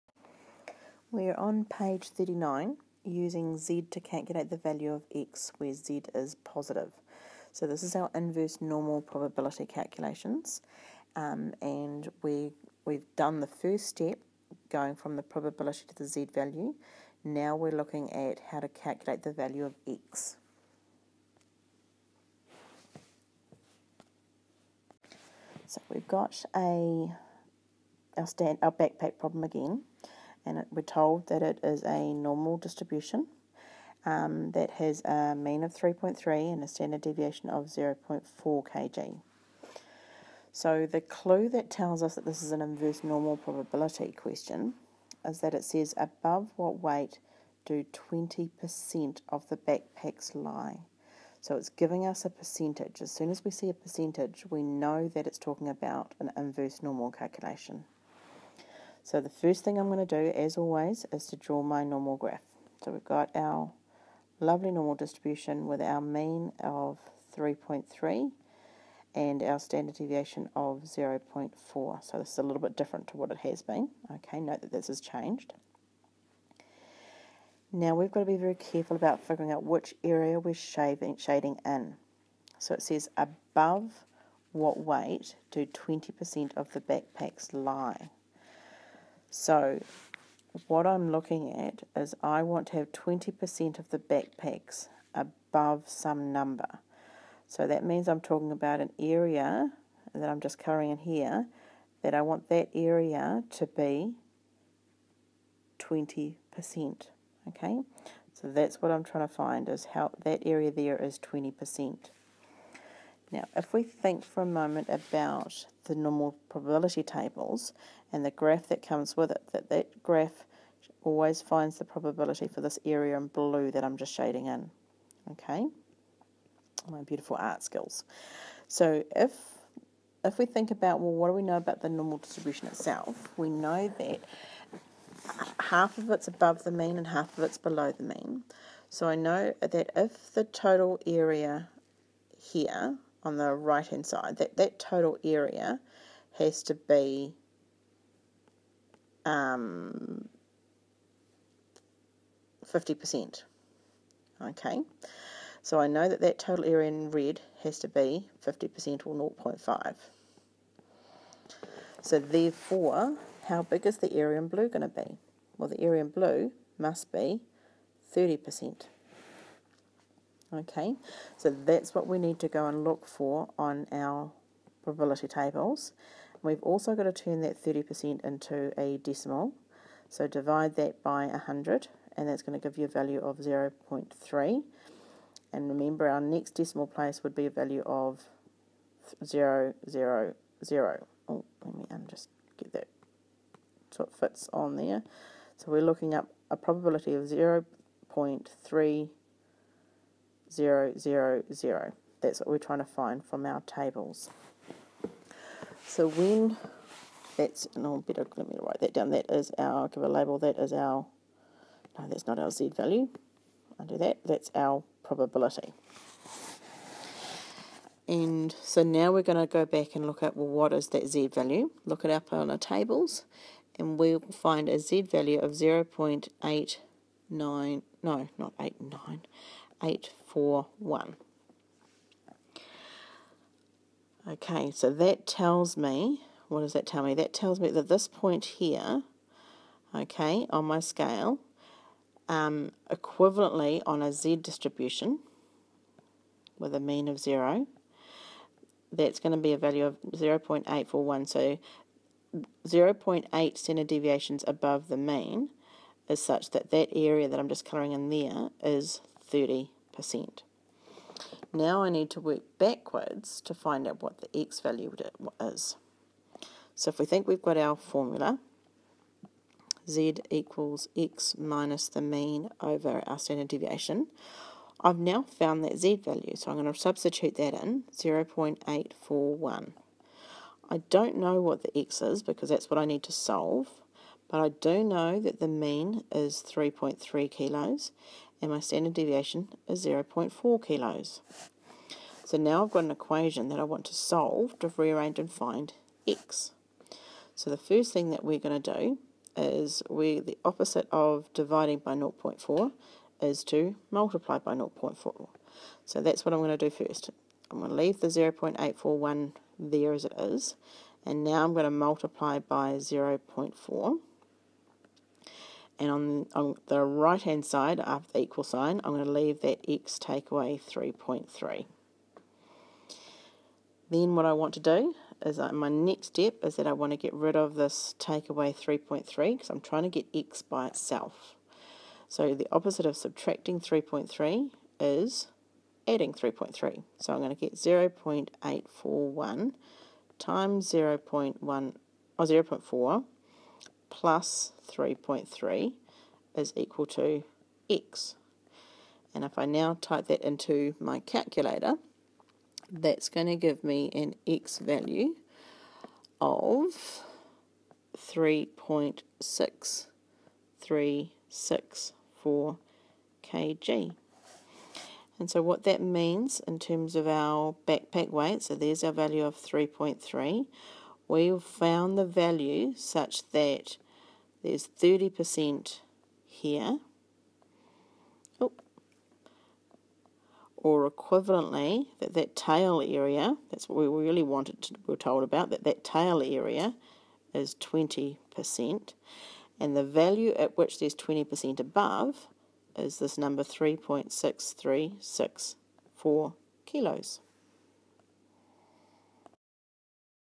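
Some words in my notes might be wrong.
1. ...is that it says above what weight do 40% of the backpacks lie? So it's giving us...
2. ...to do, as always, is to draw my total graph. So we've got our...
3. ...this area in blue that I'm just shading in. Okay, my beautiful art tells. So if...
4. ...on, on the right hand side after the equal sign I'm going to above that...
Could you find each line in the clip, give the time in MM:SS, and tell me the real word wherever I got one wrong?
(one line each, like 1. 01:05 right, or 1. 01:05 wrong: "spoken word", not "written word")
1. 00:45 wrong: "20", not "40"
2. 01:00 wrong: "normal", not "total"
3. 02:02 wrong: "skills", not "tells"
4. 05:15 wrong: "leave", not "above".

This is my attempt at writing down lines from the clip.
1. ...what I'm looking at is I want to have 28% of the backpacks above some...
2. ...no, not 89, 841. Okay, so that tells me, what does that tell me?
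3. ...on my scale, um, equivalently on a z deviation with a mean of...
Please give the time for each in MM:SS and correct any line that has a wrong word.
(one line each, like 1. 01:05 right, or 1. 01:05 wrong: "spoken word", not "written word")
1. 01:30 wrong: "20", not "28"
2. 03:47 right
3. 04:00 wrong: "distribution", not "deviation".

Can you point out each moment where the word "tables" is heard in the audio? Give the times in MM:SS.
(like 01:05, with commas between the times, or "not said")
01:57, 02:55, 03:23, 03:42.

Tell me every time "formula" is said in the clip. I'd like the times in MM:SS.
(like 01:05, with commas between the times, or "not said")
04:27.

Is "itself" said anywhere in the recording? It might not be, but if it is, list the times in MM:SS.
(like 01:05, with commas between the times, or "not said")
02:12, 05:30.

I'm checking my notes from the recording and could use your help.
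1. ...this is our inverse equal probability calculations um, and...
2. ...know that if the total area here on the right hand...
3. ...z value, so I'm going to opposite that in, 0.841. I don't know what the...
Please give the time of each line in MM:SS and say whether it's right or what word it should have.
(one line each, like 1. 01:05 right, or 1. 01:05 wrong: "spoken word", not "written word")
1. 00:07 wrong: "normal", not "equal"
2. 02:19 right
3. 04:35 wrong: "substitute", not "opposite".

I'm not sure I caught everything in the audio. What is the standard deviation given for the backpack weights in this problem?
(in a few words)
0.4 kg.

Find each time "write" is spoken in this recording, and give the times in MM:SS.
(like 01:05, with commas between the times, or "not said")
03:28.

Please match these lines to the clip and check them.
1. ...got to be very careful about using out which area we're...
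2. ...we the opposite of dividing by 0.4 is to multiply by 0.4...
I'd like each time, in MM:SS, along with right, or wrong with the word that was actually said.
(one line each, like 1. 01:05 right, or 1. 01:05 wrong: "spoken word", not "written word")
1. 01:18 wrong: "figuring", not "using"
2. 04:59 right.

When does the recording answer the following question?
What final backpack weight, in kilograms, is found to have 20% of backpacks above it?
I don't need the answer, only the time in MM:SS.
05:57.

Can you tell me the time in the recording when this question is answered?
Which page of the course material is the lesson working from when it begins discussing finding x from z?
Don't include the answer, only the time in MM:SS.
00:02.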